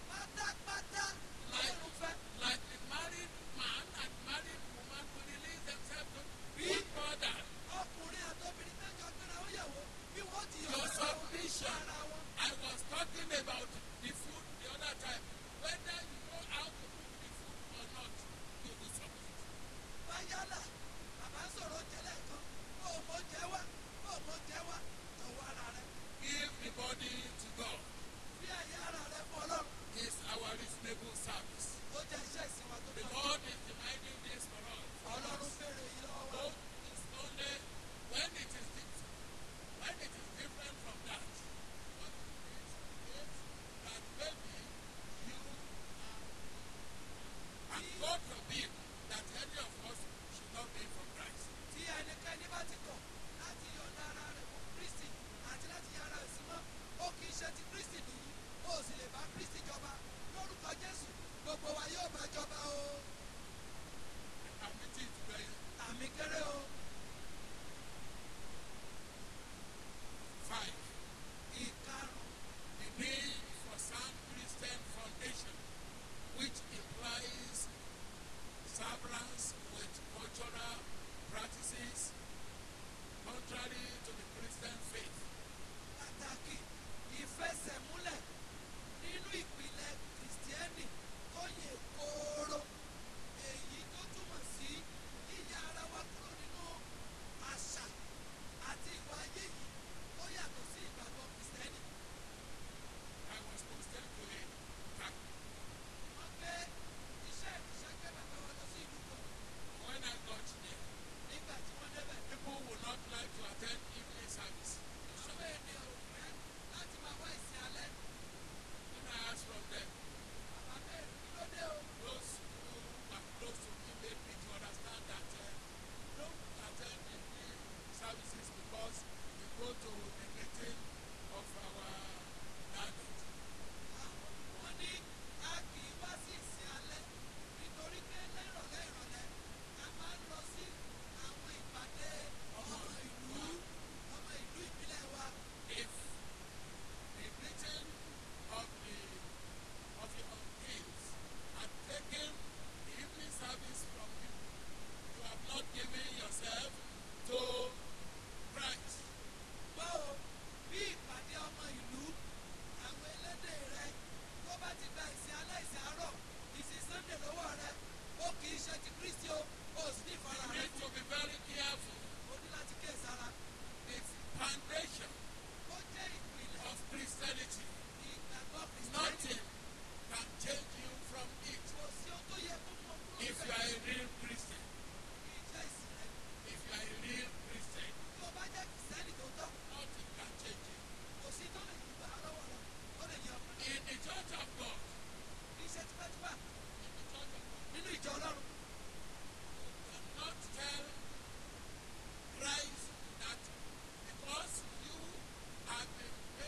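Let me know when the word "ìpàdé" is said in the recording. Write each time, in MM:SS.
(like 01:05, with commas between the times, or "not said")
02:21, 02:40.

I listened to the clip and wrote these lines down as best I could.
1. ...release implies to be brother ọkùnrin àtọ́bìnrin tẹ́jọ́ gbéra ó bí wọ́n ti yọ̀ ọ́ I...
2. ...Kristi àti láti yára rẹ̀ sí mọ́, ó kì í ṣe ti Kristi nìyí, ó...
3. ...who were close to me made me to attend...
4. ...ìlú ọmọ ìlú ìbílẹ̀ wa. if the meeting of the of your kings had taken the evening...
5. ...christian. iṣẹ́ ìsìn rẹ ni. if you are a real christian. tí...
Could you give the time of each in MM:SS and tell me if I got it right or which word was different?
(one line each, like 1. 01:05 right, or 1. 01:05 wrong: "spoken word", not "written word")
1. 00:05 wrong: "themselves", not "implies"
2. 00:54 right
3. 02:02 wrong: "understand", not "attend"
4. 02:23 right
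5. 03:04 right.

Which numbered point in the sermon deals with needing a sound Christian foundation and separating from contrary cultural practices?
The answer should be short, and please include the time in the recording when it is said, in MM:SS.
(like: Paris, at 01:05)
5, at 01:10.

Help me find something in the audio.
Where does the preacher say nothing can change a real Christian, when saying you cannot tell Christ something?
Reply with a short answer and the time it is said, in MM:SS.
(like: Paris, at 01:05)
The church of God, at 03:13.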